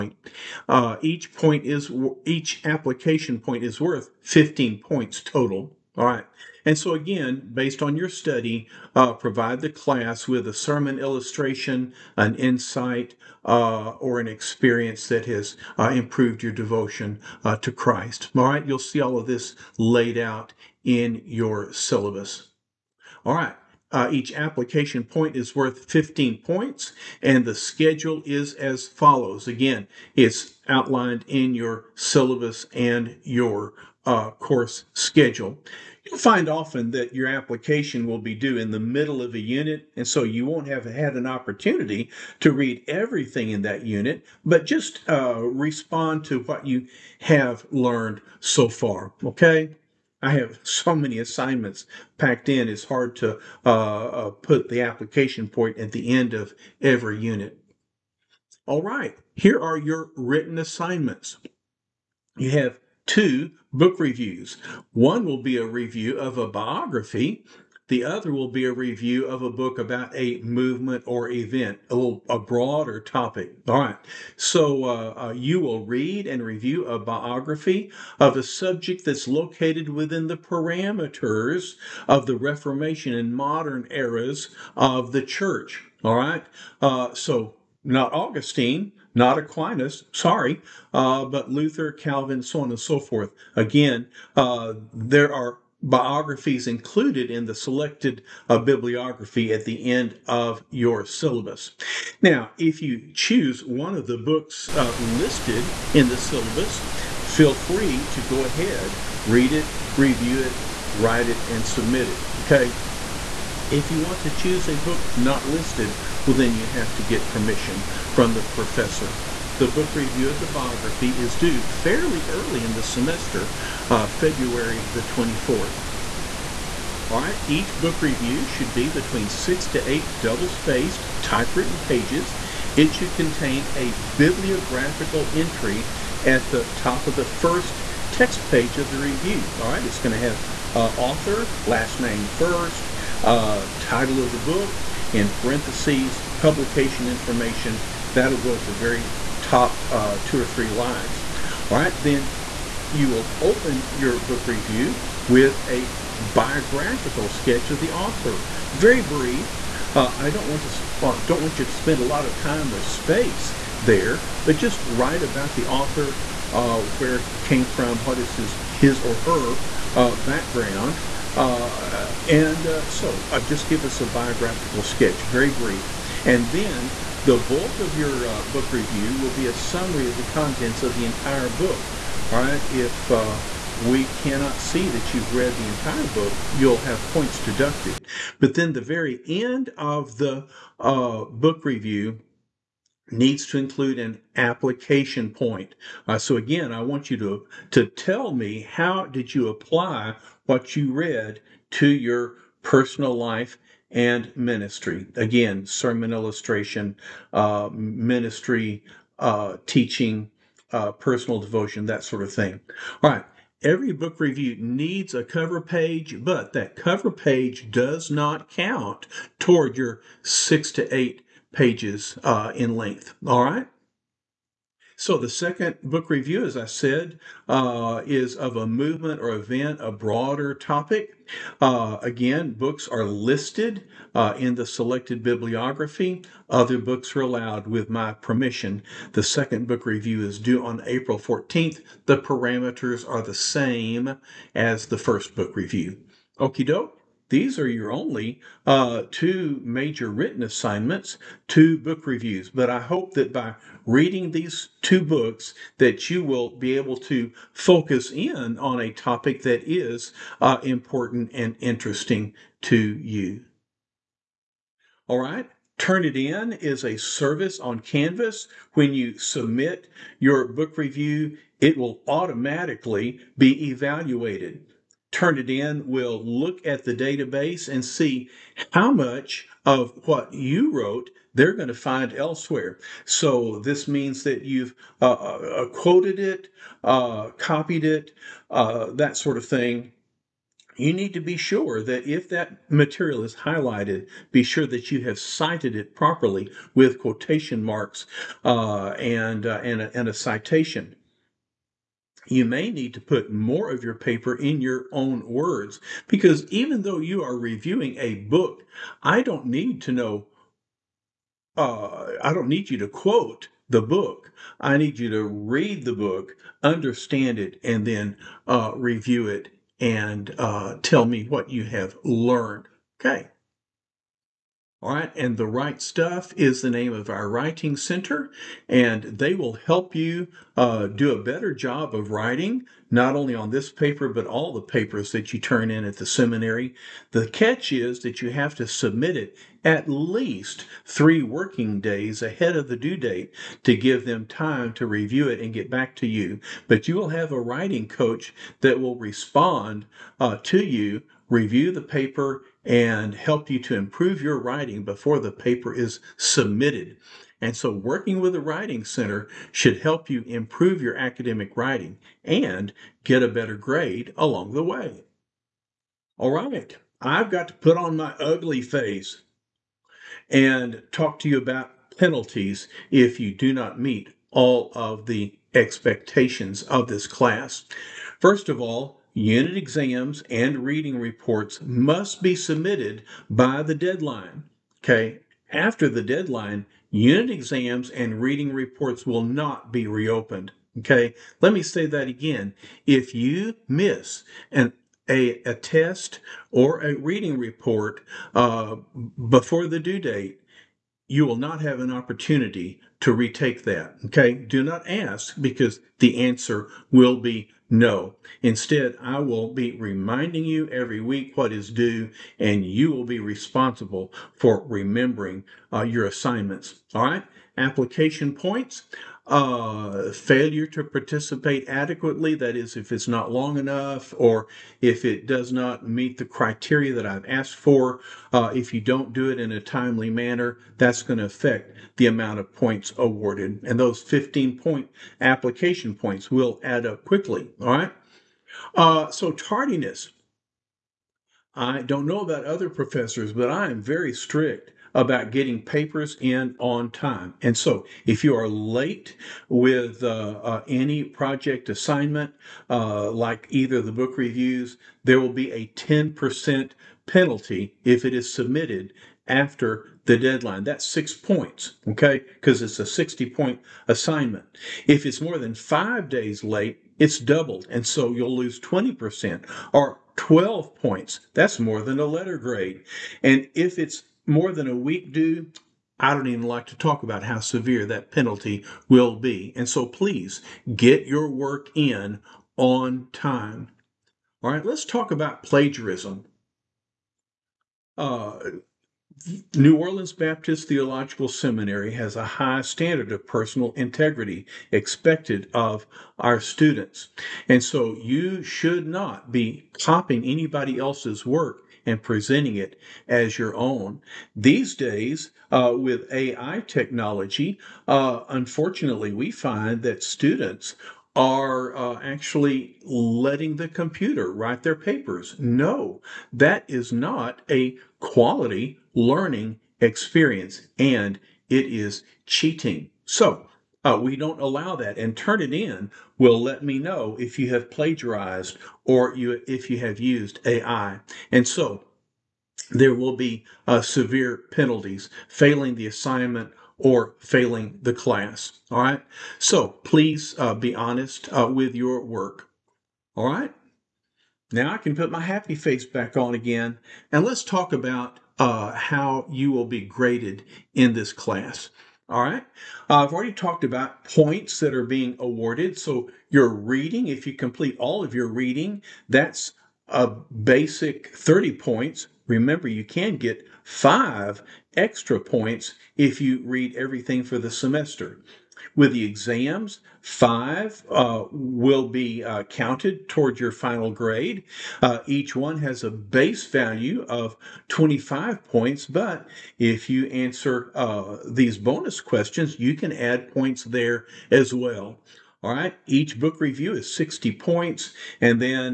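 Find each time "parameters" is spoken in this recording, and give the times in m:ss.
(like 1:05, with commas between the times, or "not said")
1:20, 4:02.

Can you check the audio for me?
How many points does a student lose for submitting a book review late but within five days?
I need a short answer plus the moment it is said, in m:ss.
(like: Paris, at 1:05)
6, at 7:40.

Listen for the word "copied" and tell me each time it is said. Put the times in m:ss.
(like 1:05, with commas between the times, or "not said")
4:47.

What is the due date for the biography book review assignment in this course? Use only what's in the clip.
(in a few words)
February 24th.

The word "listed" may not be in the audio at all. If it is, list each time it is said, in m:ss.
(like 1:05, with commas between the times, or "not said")
1:44, 1:55, 3:53.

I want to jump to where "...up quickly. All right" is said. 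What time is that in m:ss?
7:16.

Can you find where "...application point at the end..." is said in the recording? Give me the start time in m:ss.
0:54.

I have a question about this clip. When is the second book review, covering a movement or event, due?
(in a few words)
April 14th.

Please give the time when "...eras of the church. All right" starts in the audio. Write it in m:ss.
1:23.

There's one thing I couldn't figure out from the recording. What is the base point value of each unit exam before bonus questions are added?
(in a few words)
25.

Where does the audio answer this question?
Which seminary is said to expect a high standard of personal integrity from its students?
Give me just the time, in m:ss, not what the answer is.
8:09.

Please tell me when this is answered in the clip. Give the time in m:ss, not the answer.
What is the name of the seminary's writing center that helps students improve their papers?
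5:25.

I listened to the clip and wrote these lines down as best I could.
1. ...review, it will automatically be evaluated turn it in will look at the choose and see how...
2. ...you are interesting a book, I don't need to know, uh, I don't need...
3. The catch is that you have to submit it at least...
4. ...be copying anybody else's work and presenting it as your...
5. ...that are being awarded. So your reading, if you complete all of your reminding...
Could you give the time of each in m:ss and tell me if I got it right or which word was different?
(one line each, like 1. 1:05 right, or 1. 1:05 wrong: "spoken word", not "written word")
1. 4:30 wrong: "database", not "choose"
2. 5:06 wrong: "reviewing", not "interesting"
3. 5:37 right
4. 8:19 right
5. 9:14 wrong: "reading", not "reminding".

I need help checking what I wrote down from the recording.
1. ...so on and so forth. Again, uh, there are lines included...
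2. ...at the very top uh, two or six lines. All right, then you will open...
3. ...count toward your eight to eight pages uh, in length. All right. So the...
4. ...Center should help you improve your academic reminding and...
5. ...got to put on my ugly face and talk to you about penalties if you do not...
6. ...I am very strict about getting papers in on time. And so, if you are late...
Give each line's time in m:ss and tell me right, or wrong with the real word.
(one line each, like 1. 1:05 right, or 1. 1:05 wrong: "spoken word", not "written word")
1. 1:32 wrong: "biographies", not "lines"
2. 2:28 wrong: "three", not "six"
3. 3:38 wrong: "six", not "eight"
4. 5:58 wrong: "writing", not "reminding"
5. 6:07 right
6. 7:23 right.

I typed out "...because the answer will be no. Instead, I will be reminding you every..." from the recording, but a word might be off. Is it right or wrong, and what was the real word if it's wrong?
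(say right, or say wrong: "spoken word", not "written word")
right.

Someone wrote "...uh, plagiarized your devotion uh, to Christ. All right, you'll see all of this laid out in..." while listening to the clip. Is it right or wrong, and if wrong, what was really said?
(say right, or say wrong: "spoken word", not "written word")
wrong: "improved", not "plagiarized".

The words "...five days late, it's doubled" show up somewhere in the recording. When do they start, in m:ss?
7:45.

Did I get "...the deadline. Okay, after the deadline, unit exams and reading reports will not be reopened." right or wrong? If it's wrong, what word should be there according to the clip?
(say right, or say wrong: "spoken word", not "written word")
right.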